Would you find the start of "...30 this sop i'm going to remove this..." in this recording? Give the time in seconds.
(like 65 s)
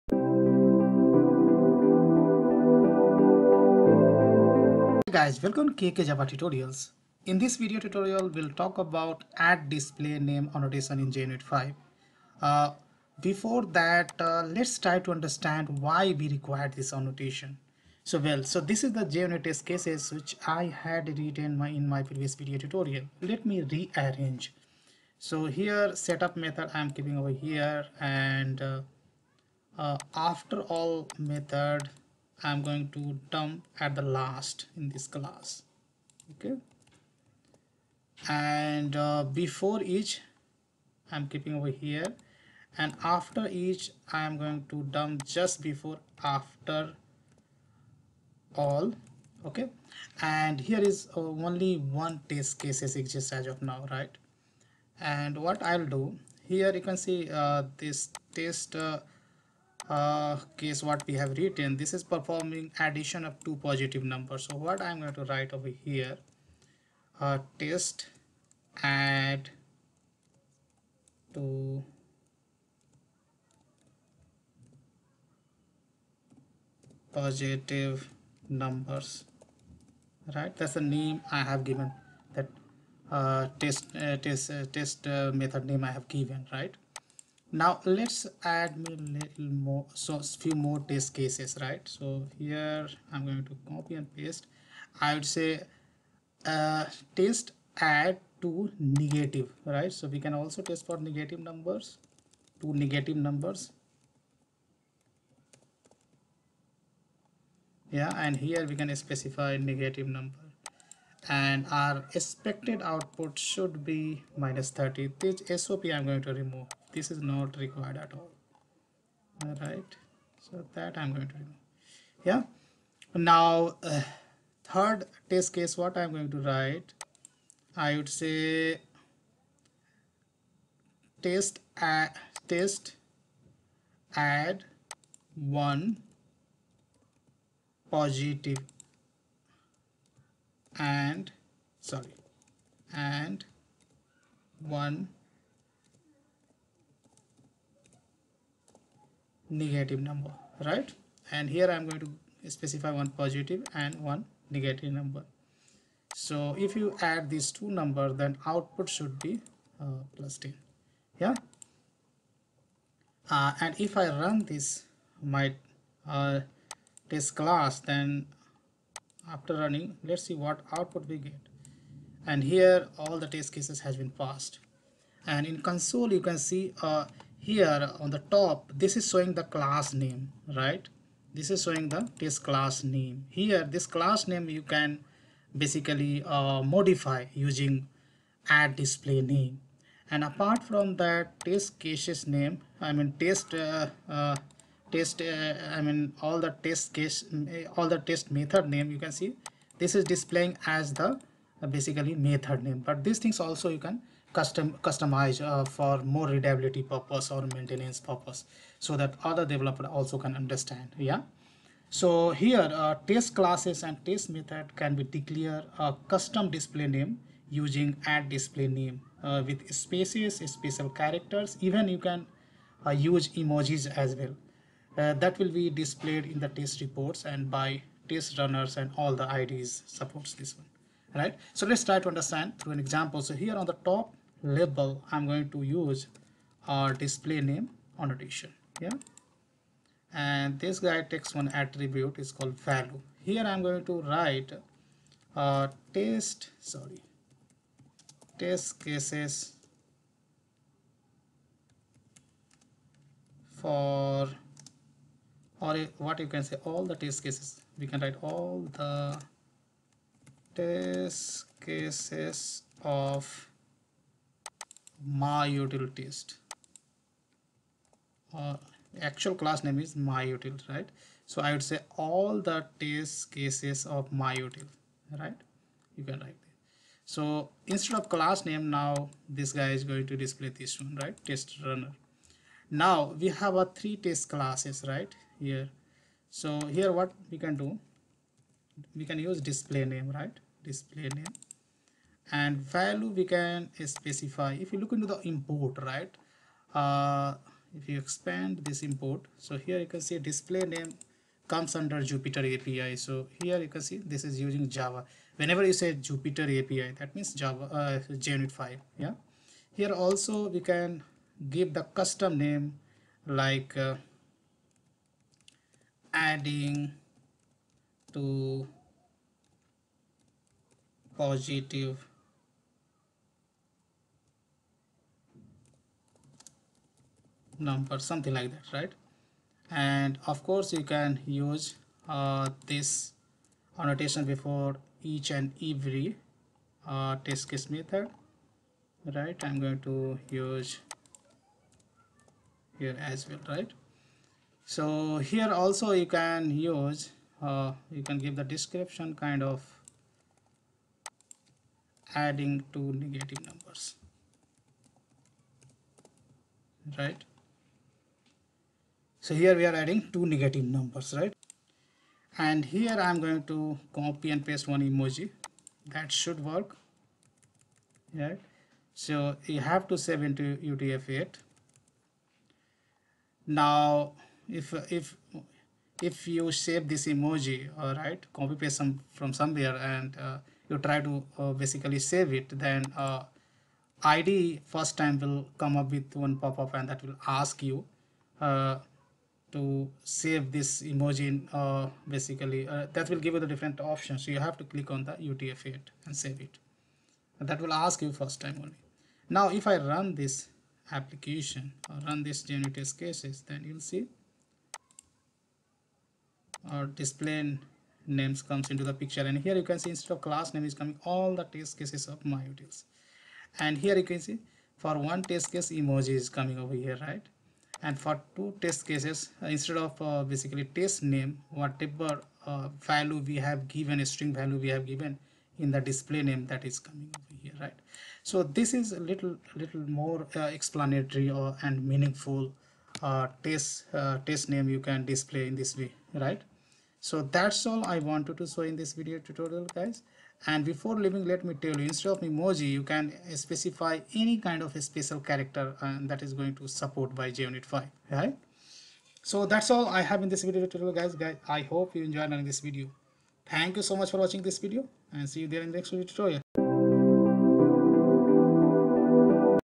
114 s.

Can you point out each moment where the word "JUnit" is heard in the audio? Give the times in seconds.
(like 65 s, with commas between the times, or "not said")
11 s, 19 s, 308 s, 402 s, 447 s.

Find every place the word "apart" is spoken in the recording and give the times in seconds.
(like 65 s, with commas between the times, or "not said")
190 s.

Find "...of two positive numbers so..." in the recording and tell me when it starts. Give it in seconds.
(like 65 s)
63 s.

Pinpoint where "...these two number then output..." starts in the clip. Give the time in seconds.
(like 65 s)
157 s.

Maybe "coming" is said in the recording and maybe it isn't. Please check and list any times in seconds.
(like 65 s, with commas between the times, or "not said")
410 s, 416 s, 426 s.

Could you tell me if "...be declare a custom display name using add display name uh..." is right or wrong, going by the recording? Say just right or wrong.
right.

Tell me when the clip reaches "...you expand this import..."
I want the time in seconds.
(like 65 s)
297 s.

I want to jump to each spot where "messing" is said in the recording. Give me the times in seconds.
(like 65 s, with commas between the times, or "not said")
not said.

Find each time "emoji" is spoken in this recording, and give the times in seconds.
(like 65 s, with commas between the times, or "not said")
223 s, 364 s, 377 s, 390 s, 415 s, 442 s.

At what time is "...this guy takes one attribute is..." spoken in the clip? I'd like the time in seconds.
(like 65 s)
240 s.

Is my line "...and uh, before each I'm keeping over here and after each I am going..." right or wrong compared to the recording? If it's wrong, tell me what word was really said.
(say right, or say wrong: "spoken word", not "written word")
right.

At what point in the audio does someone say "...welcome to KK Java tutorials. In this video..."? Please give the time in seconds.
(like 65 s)
5 s.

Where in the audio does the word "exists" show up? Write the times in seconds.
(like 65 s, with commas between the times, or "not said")
52 s.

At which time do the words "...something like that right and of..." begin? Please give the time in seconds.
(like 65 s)
328 s.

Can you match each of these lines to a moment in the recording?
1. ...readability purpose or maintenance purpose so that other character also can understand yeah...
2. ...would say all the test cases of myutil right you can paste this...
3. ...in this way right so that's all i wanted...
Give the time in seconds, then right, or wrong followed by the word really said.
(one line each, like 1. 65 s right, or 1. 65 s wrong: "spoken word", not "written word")
1. 206 s wrong: "developer", not "character"
2. 271 s wrong: "write", not "paste"
3. 435 s right.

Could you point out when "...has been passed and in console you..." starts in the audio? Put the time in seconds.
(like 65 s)
173 s.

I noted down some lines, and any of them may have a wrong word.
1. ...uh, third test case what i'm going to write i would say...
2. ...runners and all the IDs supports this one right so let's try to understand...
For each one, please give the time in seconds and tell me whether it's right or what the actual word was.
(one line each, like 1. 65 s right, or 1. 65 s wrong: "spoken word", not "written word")
1. 123 s right
2. 228 s right.